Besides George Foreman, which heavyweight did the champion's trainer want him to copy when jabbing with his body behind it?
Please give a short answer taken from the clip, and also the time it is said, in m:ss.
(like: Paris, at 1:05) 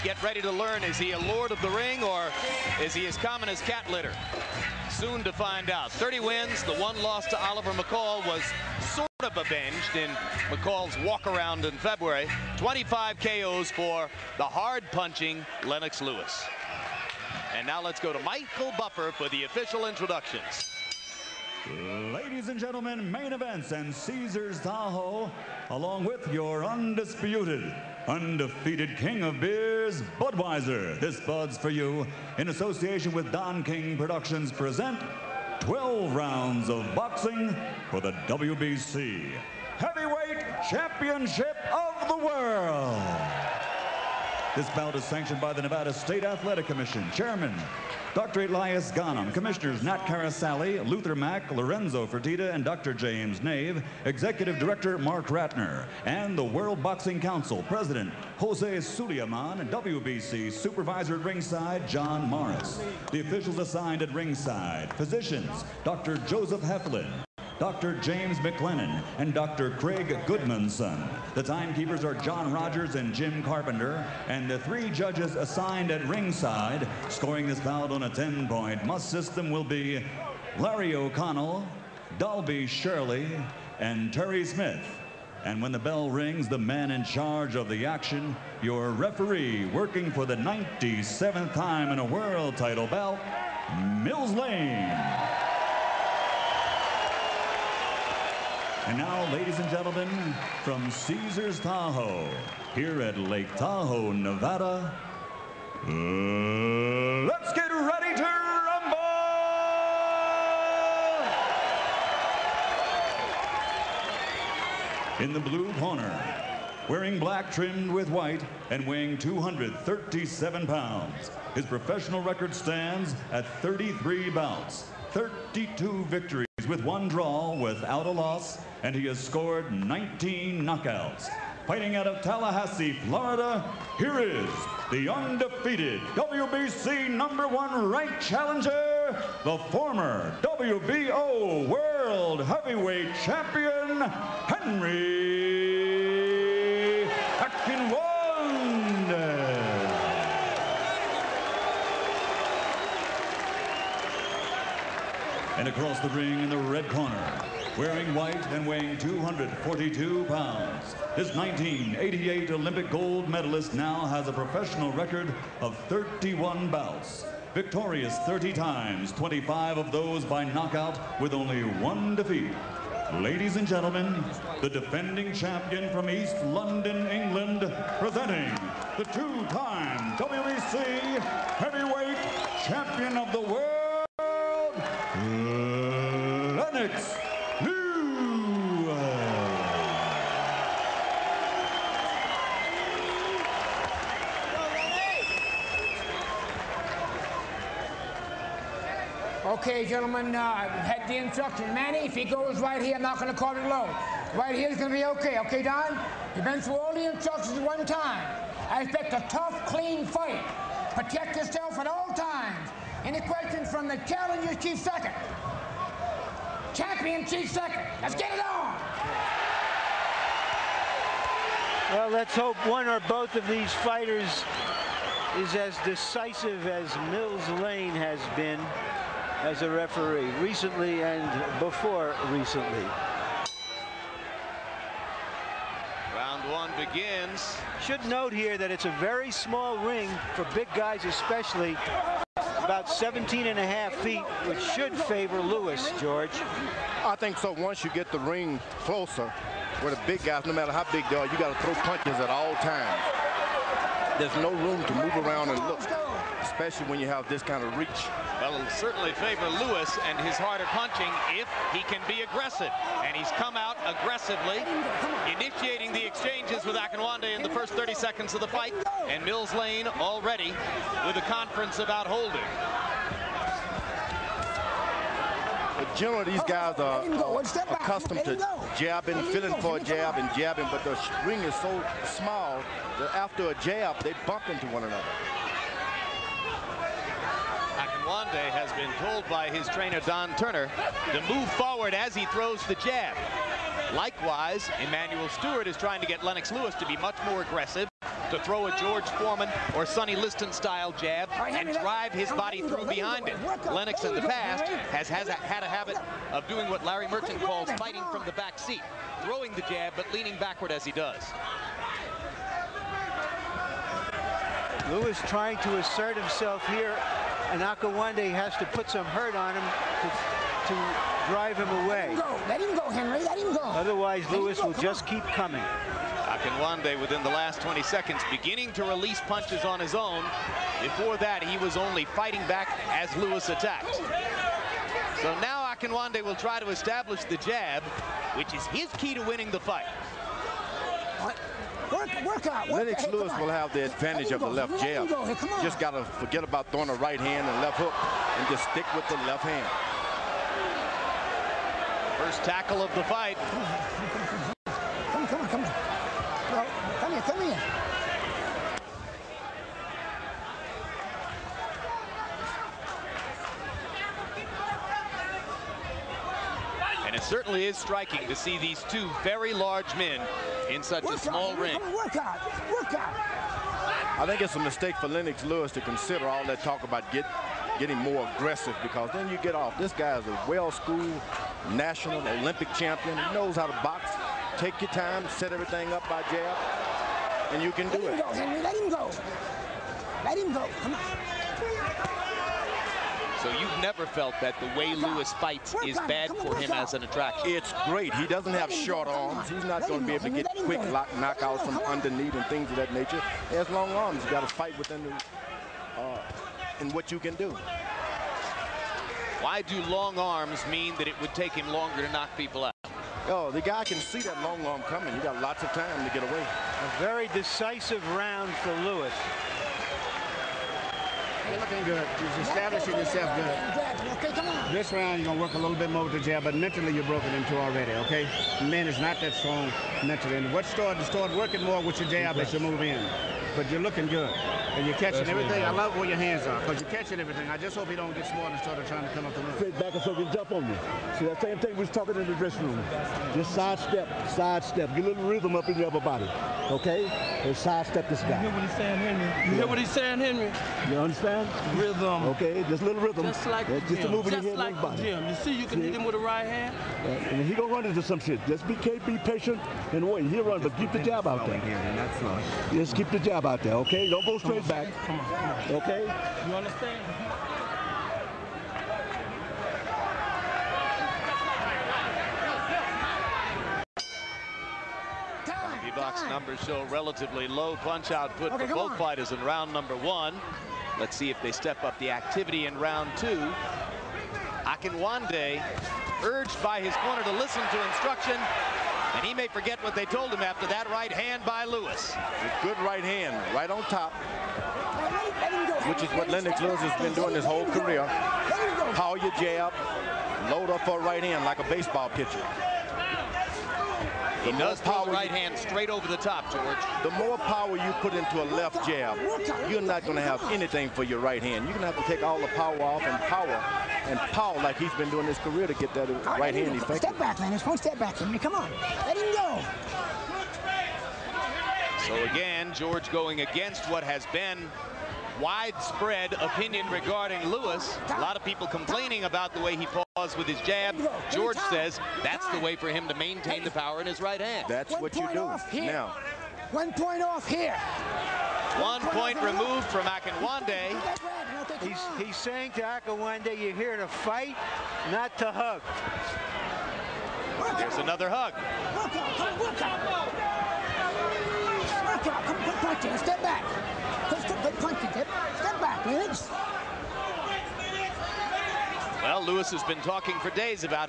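Sonny Liston, at 4:59.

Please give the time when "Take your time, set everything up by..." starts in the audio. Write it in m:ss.
6:24.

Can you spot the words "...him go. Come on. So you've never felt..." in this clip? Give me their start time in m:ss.
6:30.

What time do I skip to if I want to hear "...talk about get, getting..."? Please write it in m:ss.
6:16.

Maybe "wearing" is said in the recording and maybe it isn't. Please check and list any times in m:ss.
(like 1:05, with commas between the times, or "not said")
1:56, 2:37.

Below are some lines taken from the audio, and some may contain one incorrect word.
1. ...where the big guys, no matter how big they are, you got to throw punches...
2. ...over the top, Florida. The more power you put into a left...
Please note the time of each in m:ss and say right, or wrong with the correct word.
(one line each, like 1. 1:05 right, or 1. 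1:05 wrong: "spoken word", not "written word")
1. 4:09 right
2. 8:25 wrong: "George", not "Florida".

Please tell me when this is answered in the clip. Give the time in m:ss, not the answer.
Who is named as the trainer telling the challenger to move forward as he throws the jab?
4:50.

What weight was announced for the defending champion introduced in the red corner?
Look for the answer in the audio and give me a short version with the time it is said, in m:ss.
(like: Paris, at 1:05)
242 pounds, at 2:38.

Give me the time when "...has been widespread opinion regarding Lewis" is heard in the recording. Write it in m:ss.
8:44.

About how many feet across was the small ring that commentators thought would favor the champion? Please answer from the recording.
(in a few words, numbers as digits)
17.5.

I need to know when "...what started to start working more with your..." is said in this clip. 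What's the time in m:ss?
7:10.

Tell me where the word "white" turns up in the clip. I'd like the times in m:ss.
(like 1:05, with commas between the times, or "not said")
1:58, 2:38.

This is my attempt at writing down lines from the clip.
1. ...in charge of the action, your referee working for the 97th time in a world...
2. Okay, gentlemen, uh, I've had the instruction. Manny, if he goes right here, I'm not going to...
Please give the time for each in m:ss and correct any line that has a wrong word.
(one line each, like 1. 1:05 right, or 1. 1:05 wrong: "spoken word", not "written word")
1. 1:26 right
2. 3:19 right.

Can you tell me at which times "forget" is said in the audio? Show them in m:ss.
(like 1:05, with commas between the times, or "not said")
5:46, 8:09.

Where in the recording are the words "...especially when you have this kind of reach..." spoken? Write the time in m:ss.
4:16.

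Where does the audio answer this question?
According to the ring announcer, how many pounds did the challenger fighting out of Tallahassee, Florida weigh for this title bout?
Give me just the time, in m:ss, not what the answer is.
1:59.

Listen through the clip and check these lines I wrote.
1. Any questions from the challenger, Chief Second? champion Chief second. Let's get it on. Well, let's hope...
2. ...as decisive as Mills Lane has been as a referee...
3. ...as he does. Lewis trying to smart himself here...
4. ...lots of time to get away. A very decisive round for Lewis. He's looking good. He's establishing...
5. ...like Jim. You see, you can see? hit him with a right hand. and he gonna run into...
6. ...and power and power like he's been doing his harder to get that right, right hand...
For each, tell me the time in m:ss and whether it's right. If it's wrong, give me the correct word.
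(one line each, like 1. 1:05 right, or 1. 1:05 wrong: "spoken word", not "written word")
1. 3:33 right
2. 3:45 right
3. 5:10 wrong: "assert", not "smart"
4. 6:55 right
5. 7:34 right
6. 8:33 wrong: "career", not "harder".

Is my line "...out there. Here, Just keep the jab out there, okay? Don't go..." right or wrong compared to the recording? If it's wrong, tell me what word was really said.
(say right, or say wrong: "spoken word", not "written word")
right.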